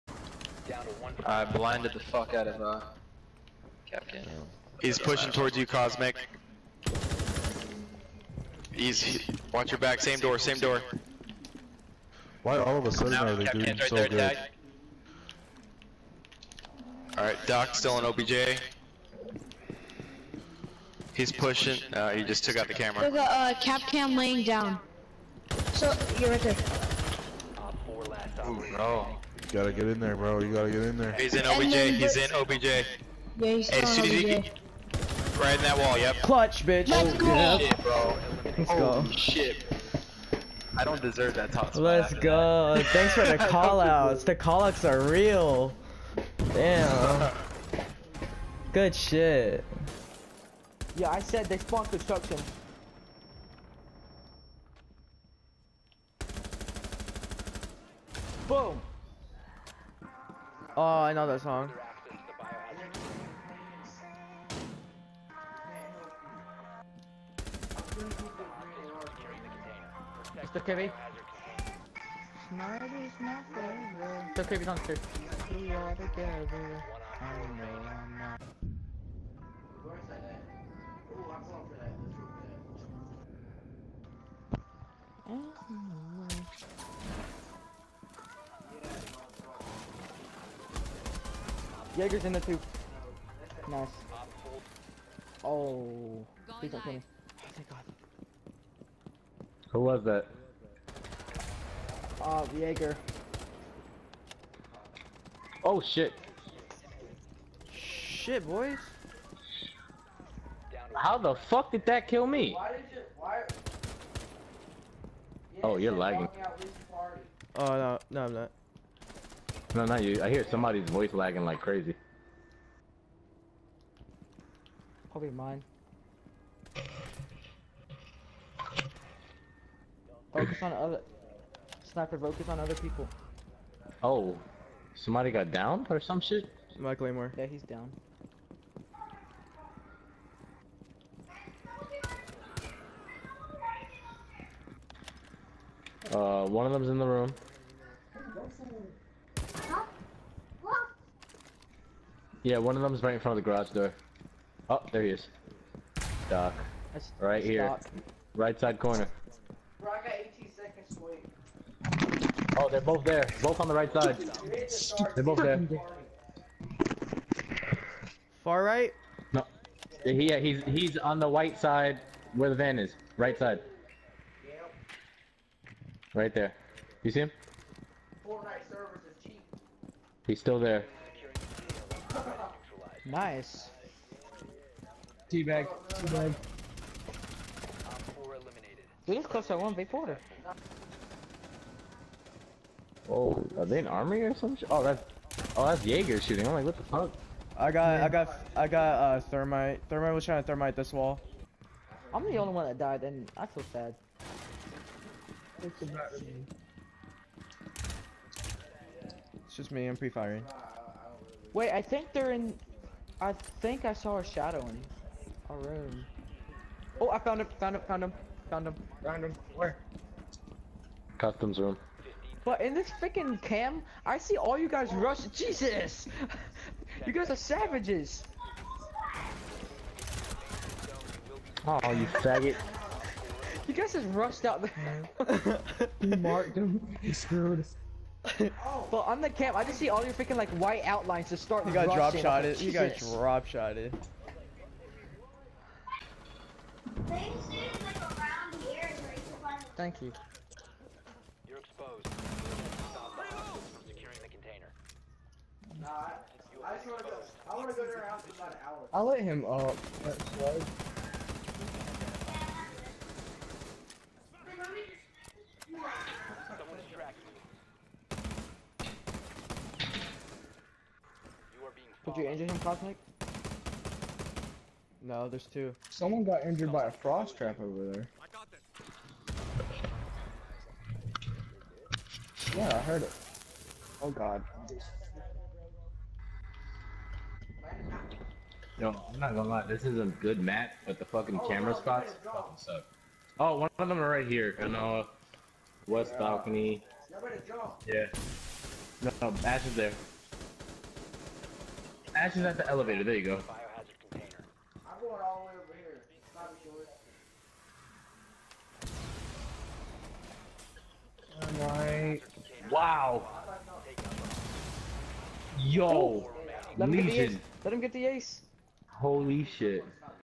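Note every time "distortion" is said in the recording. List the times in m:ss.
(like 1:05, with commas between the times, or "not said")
not said.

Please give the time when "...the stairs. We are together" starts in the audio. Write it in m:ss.
1:14.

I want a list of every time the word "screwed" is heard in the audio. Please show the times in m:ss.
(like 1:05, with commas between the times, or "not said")
3:57.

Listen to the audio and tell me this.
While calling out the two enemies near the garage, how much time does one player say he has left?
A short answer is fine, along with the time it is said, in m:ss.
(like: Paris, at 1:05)
18 seconds, at 2:40.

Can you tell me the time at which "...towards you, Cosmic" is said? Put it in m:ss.
0:05.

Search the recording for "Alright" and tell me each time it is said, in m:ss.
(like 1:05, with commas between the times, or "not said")
5:11.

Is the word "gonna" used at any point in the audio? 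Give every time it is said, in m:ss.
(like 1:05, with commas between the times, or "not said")
4:49.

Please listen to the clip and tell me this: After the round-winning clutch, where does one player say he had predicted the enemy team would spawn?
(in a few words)
Construction.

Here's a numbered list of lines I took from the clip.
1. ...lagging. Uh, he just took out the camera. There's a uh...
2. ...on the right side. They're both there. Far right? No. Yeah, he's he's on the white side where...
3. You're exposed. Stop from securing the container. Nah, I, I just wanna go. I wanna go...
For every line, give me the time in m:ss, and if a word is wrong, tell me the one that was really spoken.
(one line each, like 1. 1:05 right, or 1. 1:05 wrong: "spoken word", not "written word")
1. 0:21 wrong: "pushing", not "lagging"
2. 2:43 right
3. 4:11 right.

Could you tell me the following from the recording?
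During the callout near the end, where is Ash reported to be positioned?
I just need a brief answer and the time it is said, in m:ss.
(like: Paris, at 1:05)
At the elevator, at 5:02.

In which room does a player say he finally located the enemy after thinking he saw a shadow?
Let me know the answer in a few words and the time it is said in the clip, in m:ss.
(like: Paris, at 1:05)
Customs room, at 3:41.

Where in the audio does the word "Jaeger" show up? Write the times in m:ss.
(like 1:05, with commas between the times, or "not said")
1:31, 1:42, 3:15.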